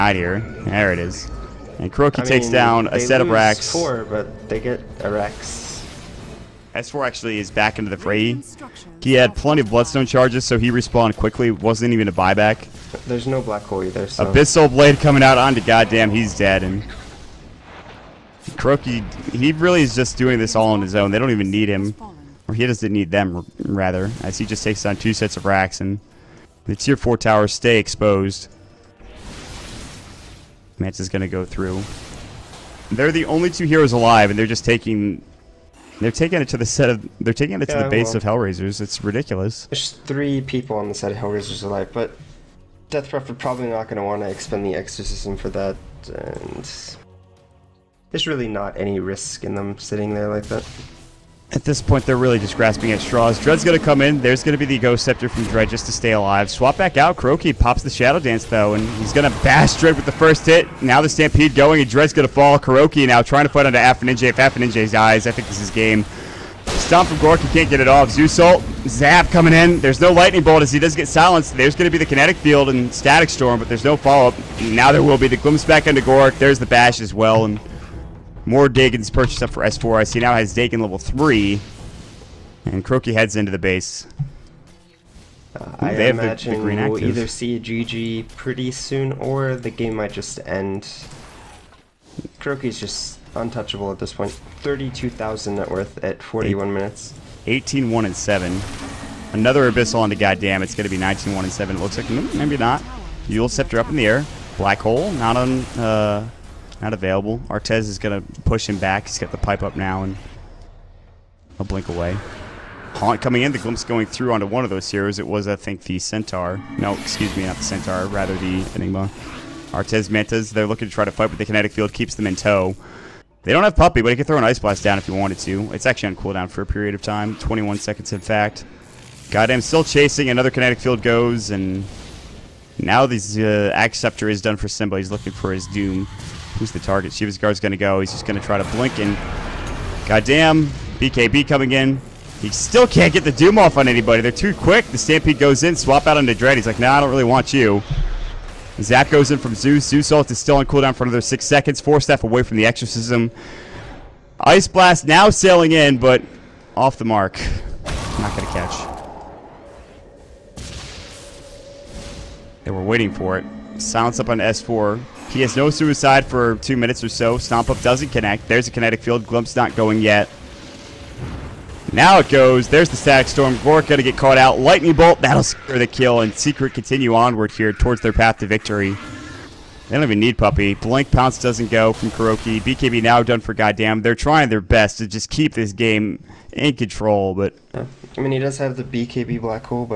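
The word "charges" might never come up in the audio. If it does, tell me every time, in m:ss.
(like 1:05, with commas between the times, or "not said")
0:10.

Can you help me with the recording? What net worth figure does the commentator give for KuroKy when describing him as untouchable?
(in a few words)
32,000.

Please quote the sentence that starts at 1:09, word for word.
There's no Lightning Bolt as he does get silenced.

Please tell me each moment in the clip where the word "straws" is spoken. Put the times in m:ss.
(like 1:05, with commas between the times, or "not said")
0:52.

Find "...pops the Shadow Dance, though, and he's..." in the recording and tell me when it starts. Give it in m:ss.
0:57.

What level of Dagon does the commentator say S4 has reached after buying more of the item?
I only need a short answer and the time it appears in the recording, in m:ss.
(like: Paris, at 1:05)
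3, at 1:20.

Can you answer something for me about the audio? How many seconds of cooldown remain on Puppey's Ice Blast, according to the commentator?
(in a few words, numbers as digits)
21.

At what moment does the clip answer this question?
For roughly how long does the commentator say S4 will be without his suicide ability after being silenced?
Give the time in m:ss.
2:46.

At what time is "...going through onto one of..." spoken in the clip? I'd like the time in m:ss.
1:53.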